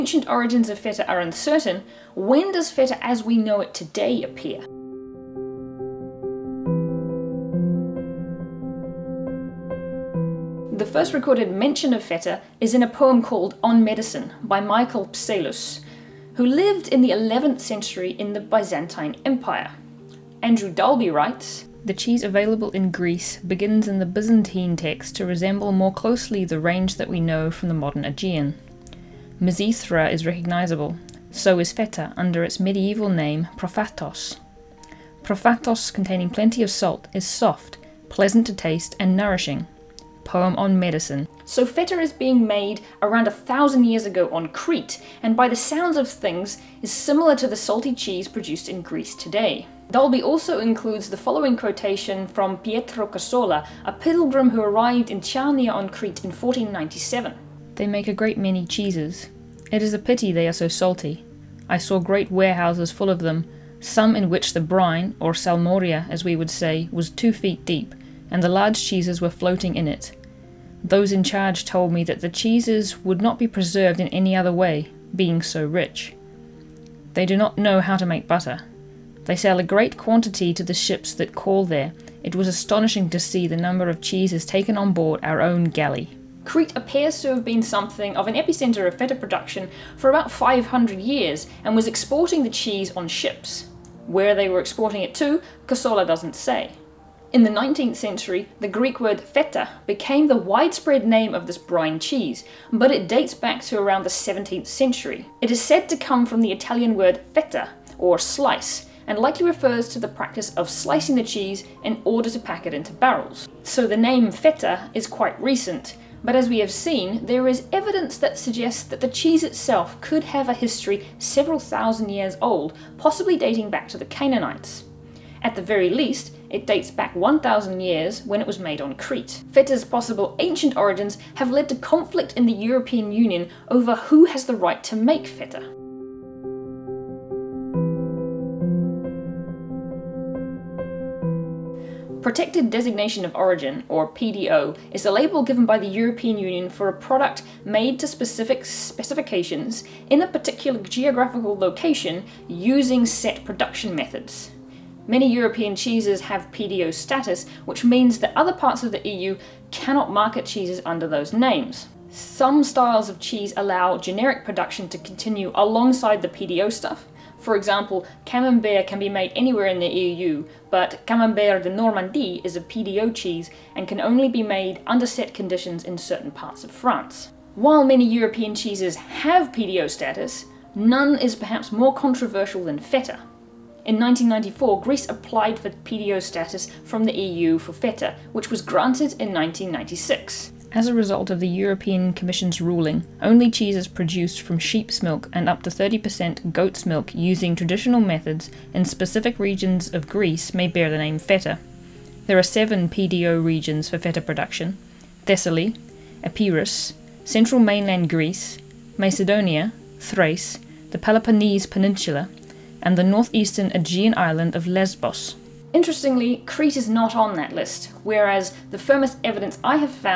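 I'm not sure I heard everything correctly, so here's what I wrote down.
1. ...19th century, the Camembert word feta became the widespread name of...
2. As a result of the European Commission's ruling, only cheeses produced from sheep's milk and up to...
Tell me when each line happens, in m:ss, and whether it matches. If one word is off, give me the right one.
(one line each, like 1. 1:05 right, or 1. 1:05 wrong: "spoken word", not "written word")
1. 1:37 wrong: "Greek", not "Camembert"
2. 3:10 right.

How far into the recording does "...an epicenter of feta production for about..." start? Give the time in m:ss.
1:28.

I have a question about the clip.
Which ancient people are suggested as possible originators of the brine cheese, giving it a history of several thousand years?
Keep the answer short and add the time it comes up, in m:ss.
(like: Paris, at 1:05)
The Canaanites, at 2:03.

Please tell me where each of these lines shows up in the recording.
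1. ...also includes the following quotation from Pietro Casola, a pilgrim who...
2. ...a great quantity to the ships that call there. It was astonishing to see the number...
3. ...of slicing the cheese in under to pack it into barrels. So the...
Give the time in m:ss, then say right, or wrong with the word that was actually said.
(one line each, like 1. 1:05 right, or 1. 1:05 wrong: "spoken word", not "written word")
1. 0:50 right
2. 1:19 right
3. 1:50 wrong: "order", not "under".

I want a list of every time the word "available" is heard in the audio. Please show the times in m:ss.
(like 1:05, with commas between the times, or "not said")
0:22.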